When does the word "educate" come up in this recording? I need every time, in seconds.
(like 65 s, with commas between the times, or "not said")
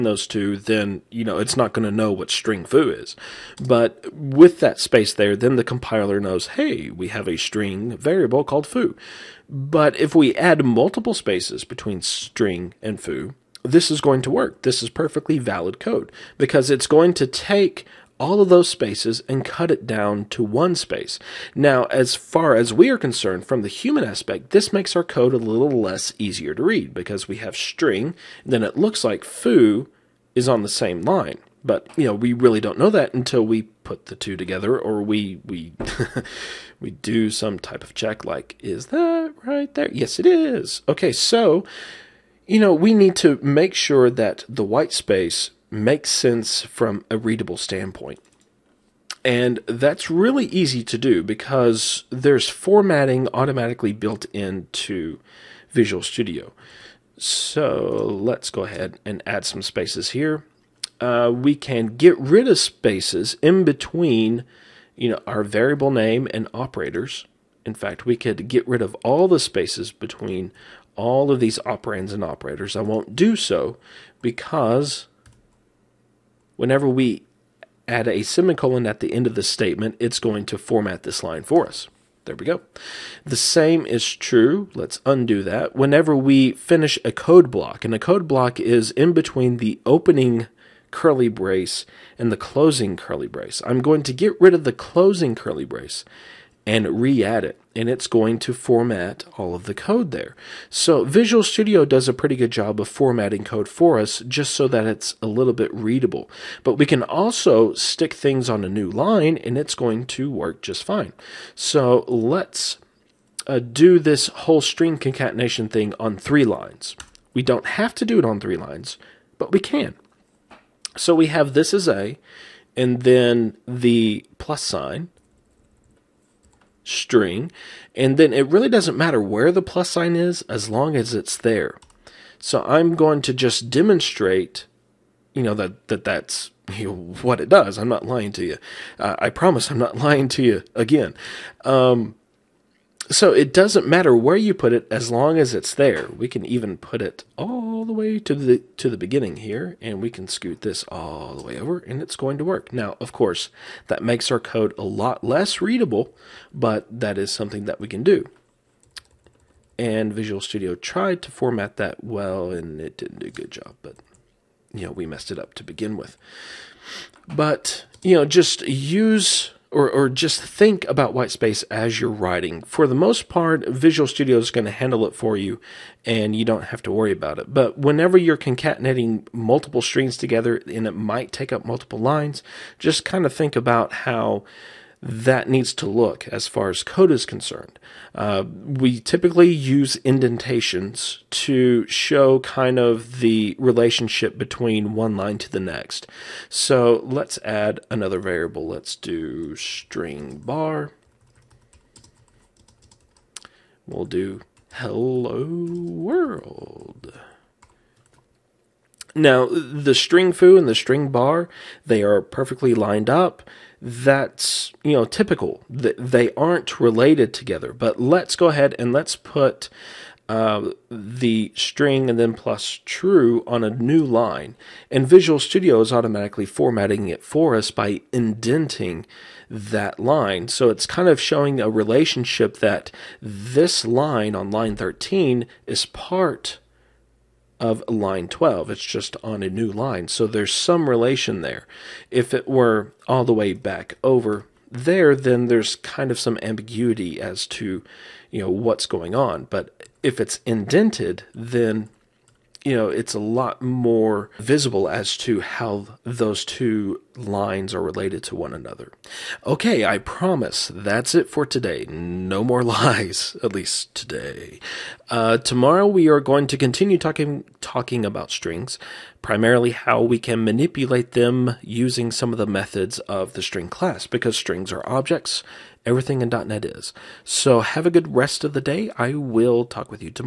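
not said.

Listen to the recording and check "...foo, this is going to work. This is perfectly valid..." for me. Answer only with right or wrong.
right.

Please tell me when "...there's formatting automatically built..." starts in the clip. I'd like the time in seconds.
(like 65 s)
52 s.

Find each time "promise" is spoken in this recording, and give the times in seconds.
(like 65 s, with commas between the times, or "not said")
139 s, 259 s.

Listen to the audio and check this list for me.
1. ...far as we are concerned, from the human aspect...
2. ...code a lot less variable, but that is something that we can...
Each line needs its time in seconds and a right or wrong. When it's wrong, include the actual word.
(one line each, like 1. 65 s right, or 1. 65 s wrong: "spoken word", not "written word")
1. 22 s right
2. 154 s wrong: "readable", not "variable".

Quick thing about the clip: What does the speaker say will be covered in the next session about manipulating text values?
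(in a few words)
methods of the string class.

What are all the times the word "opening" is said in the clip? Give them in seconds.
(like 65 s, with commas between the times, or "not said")
89 s.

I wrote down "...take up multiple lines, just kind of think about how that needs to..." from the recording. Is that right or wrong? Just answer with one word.
right.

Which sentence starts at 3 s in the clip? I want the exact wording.
But with that space there, then the compiler knows, hey, we have a string variable called foo.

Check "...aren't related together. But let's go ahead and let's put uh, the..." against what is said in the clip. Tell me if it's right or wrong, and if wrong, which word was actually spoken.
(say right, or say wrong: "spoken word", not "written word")
right.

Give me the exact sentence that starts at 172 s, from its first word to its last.
For the most part, Visual Studio is going to handle it for you and you don't have to worry about it.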